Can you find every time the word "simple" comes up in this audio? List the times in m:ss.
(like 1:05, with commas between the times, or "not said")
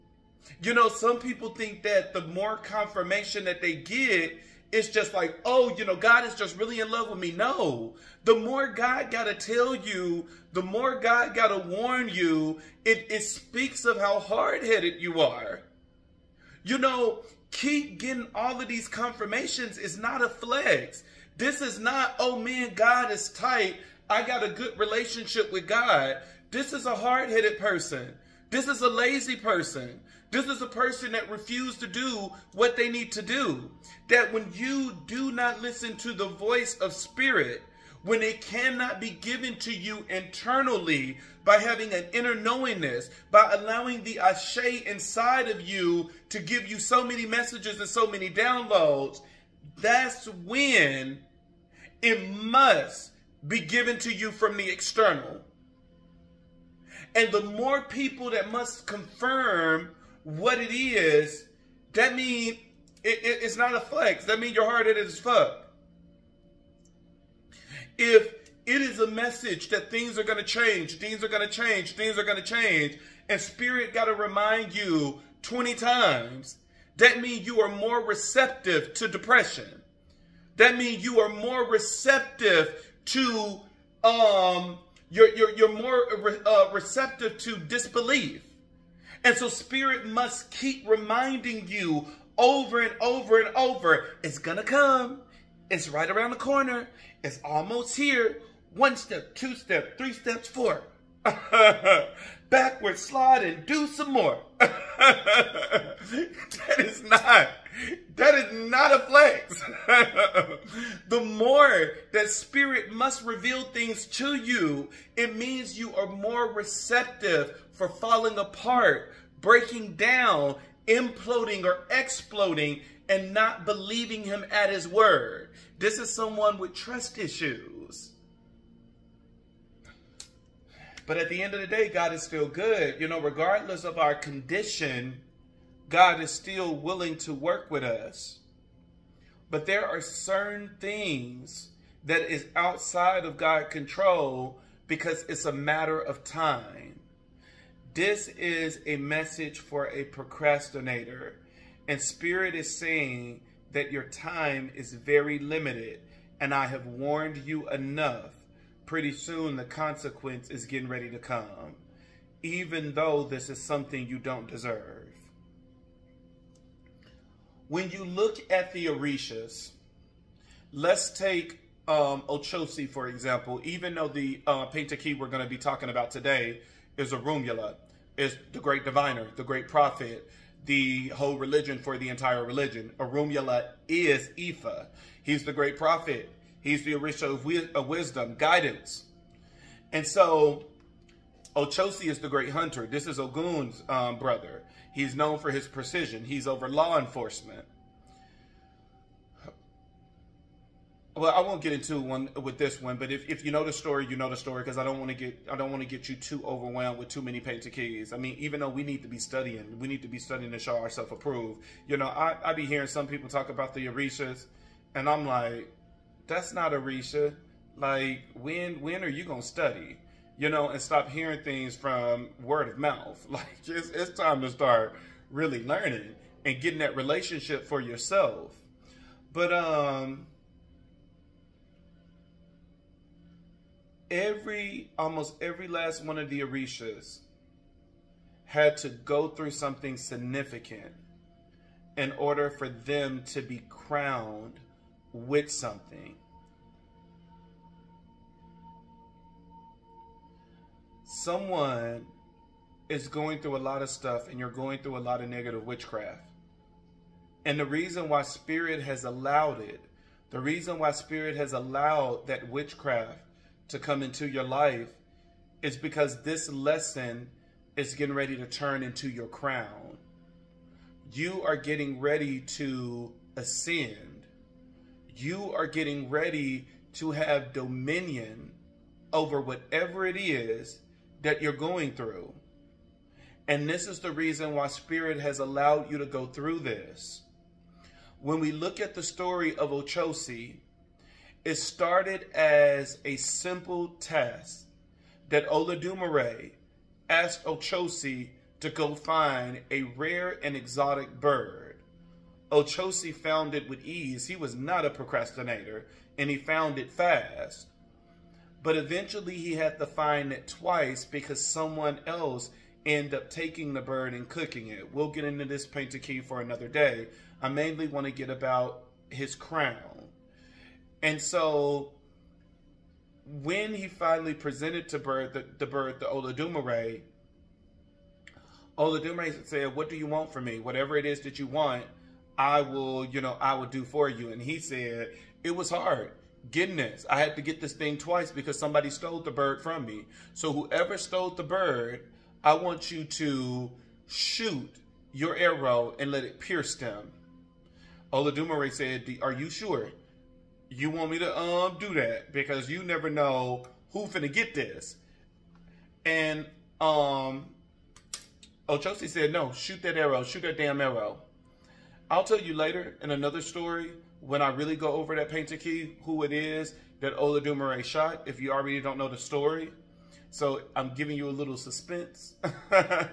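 4:53.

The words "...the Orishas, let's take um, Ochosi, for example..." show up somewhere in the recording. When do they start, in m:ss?
2:48.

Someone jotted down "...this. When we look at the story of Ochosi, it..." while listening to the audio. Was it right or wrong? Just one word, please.
right.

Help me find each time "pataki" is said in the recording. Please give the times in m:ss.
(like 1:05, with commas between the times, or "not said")
2:54, 3:27, 5:15, 6:05.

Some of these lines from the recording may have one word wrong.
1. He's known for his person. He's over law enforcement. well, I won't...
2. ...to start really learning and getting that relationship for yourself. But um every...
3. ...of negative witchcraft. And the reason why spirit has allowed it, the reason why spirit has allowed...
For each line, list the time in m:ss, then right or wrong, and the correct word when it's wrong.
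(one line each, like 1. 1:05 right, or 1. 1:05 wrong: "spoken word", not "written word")
1. 3:14 wrong: "precision", not "person"
2. 3:44 right
3. 4:15 right.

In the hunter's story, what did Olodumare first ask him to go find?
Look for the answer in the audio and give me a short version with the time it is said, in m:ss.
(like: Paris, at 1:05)
a rare and exotic bird, at 4:59.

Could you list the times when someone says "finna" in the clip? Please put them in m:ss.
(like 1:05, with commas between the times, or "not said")
5:54.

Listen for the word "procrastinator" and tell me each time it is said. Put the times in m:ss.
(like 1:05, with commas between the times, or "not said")
2:30, 5:04.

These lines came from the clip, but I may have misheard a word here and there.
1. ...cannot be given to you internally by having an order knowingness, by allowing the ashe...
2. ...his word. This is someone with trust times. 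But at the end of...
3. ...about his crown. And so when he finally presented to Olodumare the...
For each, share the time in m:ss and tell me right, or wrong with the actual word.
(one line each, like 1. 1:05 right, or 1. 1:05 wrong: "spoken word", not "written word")
1. 0:38 wrong: "inner", not "order"
2. 2:04 wrong: "issues", not "times"
3. 5:18 wrong: "Bird", not "Olodumare".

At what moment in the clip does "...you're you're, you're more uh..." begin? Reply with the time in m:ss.
1:25.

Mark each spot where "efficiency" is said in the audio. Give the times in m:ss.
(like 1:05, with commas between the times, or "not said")
not said.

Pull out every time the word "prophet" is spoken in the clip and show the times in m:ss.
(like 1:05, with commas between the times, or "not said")
2:59, 3:05.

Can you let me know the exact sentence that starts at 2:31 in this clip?
And Spirit is saying that your time is very limited.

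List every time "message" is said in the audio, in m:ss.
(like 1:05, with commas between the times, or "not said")
0:47, 1:09, 2:28.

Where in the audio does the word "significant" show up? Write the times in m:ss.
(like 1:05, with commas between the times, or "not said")
3:59.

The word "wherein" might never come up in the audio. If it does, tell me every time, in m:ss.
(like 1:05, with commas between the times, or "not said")
not said.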